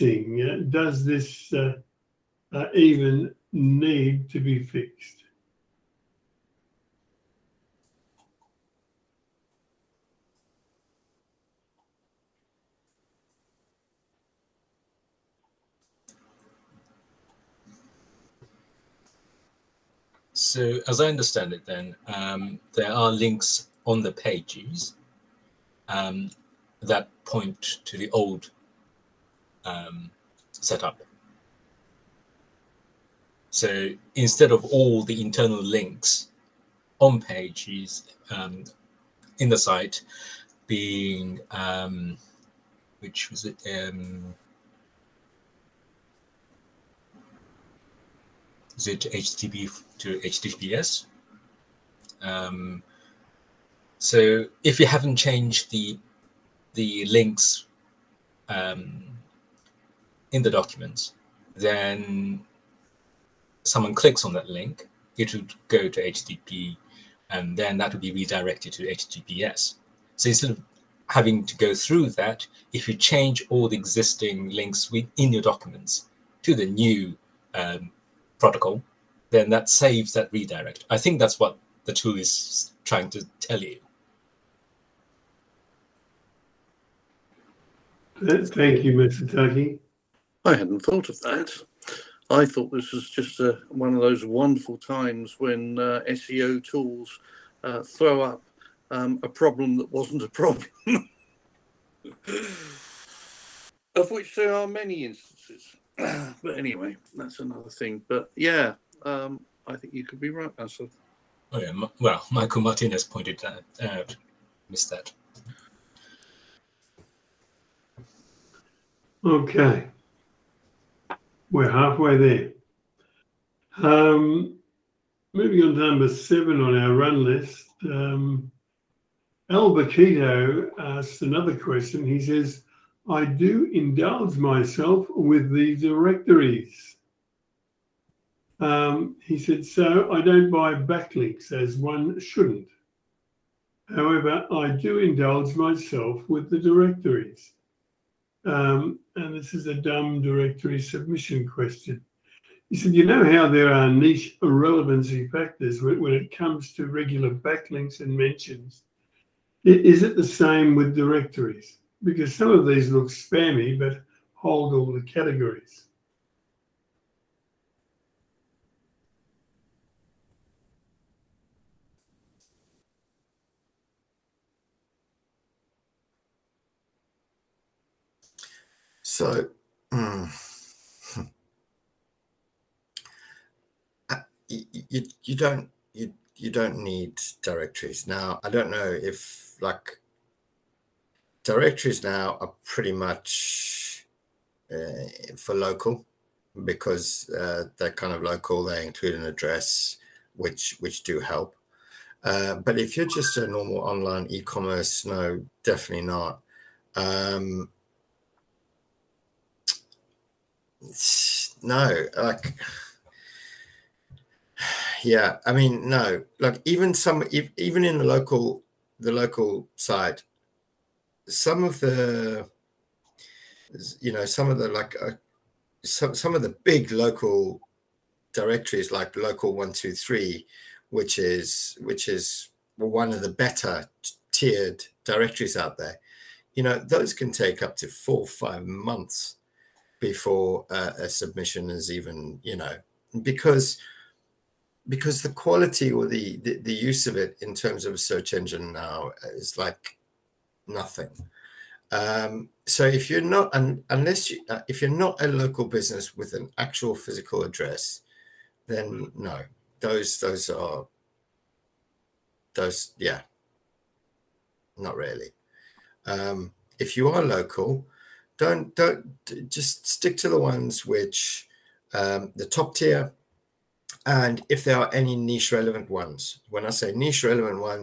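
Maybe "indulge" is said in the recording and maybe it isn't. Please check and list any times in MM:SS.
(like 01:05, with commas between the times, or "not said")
02:13, 02:24.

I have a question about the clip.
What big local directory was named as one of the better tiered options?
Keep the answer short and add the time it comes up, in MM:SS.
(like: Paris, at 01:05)
Local 123, at 03:49.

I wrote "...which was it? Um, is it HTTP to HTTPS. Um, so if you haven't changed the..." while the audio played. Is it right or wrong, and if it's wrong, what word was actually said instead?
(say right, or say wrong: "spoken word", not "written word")
right.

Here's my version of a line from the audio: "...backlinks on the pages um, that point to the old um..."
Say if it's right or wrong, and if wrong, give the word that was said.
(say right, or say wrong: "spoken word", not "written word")
wrong: "links", not "backlinks".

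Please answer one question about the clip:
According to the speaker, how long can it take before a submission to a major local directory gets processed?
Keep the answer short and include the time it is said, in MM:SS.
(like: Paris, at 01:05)
4 to 5 months, at 03:57.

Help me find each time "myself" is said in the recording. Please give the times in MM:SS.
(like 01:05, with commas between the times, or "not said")
02:14, 02:25.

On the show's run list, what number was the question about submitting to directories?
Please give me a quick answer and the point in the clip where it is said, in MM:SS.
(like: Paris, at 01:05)
7, at 02:06.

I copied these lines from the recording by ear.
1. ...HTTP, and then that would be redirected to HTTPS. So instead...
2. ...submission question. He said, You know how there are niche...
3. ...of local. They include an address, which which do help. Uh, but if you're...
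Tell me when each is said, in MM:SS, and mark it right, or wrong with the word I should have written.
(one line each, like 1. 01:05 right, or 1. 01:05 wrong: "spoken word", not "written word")
1. 01:06 right
2. 02:30 right
3. 03:18 right.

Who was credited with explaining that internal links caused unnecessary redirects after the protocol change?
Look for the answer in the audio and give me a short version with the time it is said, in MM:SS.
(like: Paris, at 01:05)
Michael Martinez, at 01:52.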